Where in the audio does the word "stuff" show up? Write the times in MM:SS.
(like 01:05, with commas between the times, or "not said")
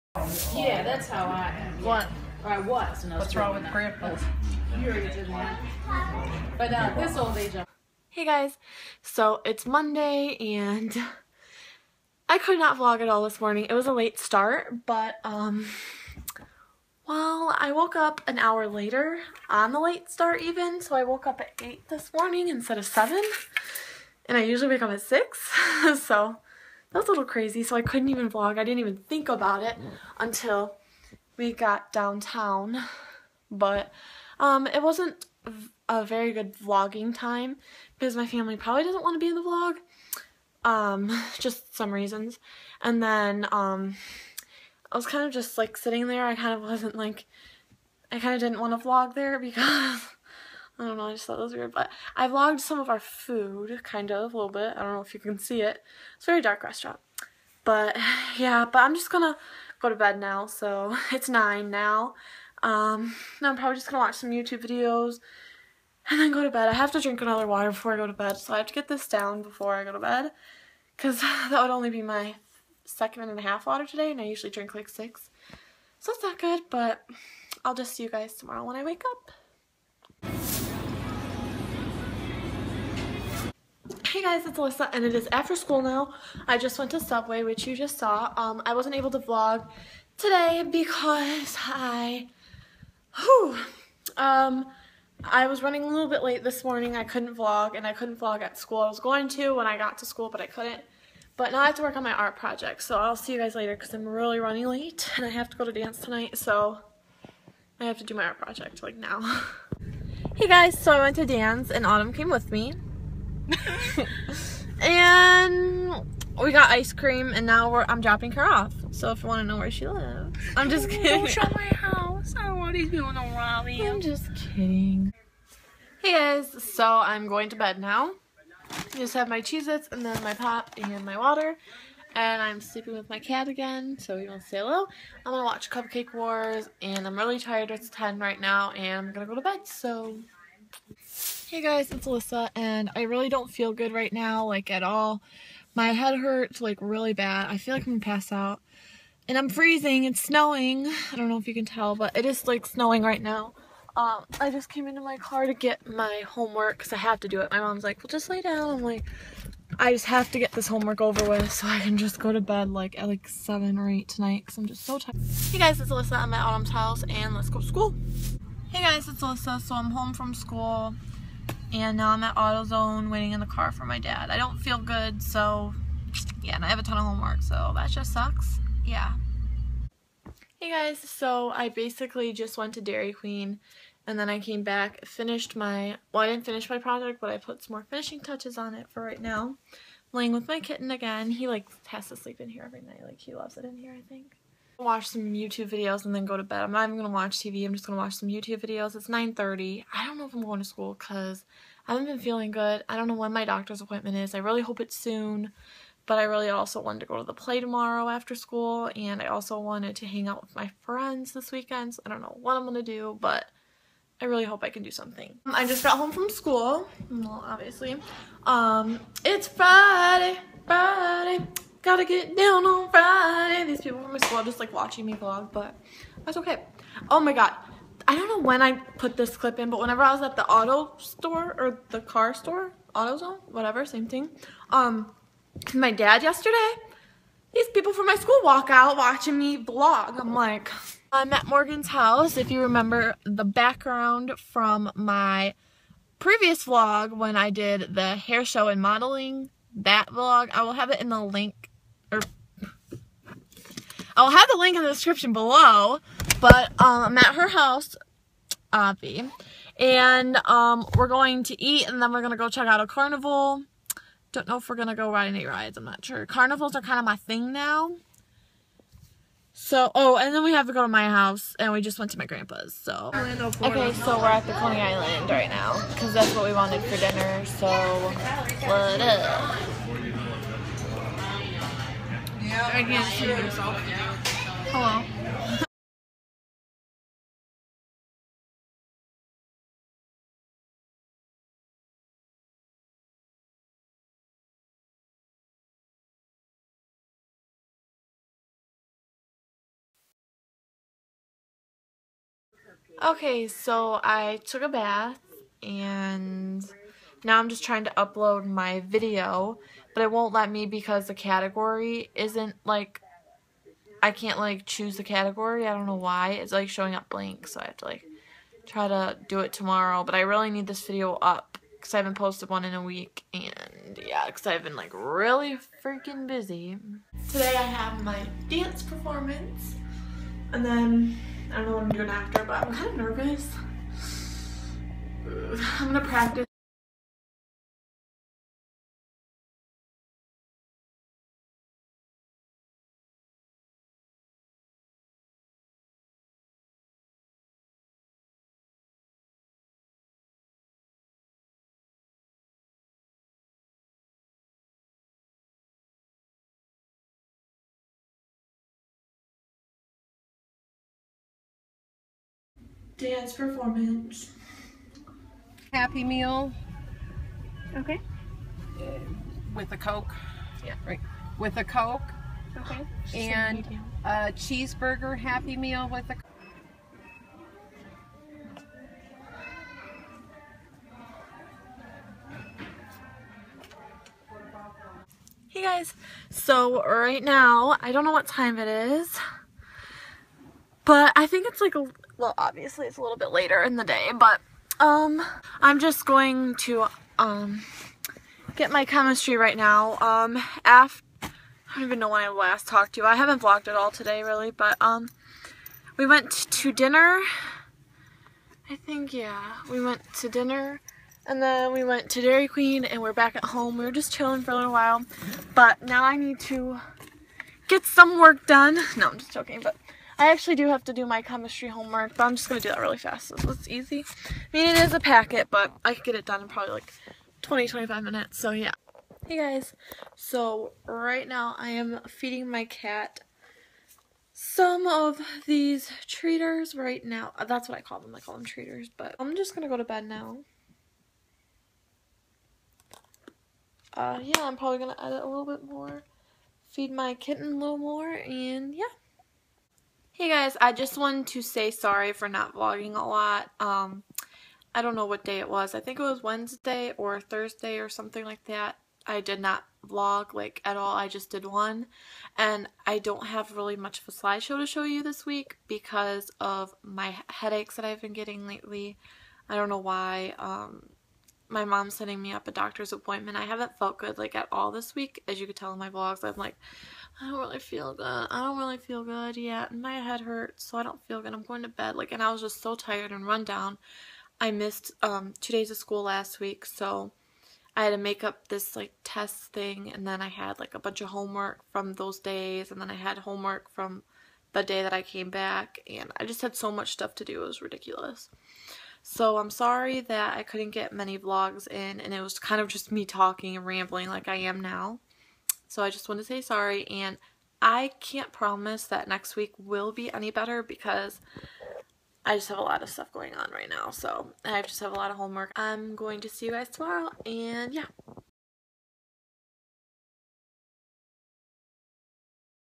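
08:16, 08:32.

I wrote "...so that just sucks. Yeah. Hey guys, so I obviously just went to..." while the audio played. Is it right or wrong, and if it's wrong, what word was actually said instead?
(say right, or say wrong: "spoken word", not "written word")
wrong: "basically", not "obviously".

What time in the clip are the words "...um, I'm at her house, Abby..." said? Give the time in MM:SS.
04:16.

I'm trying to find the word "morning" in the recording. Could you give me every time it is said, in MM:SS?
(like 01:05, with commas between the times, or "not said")
00:13, 00:22, 01:36.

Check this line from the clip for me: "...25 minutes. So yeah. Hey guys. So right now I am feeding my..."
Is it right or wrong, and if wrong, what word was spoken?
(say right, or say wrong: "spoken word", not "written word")
right.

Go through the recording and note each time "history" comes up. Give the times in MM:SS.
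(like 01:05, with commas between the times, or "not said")
not said.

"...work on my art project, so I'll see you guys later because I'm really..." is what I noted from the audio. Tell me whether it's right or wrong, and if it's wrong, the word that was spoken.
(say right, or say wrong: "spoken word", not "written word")
right.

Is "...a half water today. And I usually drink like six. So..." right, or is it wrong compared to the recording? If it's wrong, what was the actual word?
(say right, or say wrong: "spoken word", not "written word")
right.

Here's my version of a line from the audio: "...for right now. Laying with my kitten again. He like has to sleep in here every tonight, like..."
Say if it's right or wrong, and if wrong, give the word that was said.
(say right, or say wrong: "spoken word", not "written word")
wrong: "night", not "tonight".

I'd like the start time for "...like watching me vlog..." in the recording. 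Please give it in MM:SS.
03:44.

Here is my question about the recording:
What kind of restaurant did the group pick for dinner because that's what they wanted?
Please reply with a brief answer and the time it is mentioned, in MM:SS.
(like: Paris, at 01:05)
Coney Island, at 04:34.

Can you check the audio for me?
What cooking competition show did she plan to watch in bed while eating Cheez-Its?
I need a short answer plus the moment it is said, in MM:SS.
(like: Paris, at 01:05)
Cupcake Wars, at 02:15.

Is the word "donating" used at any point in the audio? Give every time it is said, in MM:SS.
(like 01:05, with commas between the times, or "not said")
not said.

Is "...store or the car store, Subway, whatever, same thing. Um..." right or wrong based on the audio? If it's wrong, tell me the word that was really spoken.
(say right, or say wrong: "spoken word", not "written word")
wrong: "AutoZone", not "Subway".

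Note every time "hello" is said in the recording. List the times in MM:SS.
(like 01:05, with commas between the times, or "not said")
02:14, 04:44.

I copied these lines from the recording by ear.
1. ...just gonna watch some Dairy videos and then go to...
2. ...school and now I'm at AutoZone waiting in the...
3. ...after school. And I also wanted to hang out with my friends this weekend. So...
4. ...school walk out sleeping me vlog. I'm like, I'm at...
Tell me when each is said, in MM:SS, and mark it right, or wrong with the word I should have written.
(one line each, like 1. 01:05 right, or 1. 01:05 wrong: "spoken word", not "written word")
1. 01:03 wrong: "YouTube", not "Dairy"
2. 02:50 right
3. 03:28 right
4. 03:58 wrong: "watching", not "sleeping".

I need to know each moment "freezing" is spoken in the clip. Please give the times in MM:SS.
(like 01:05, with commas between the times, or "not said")
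02:29.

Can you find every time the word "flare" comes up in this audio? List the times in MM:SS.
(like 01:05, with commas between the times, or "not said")
not said.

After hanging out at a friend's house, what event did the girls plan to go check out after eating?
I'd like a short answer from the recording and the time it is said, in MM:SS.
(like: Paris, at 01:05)
a carnival, at 04:22.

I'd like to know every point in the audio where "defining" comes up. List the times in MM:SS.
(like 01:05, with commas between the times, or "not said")
not said.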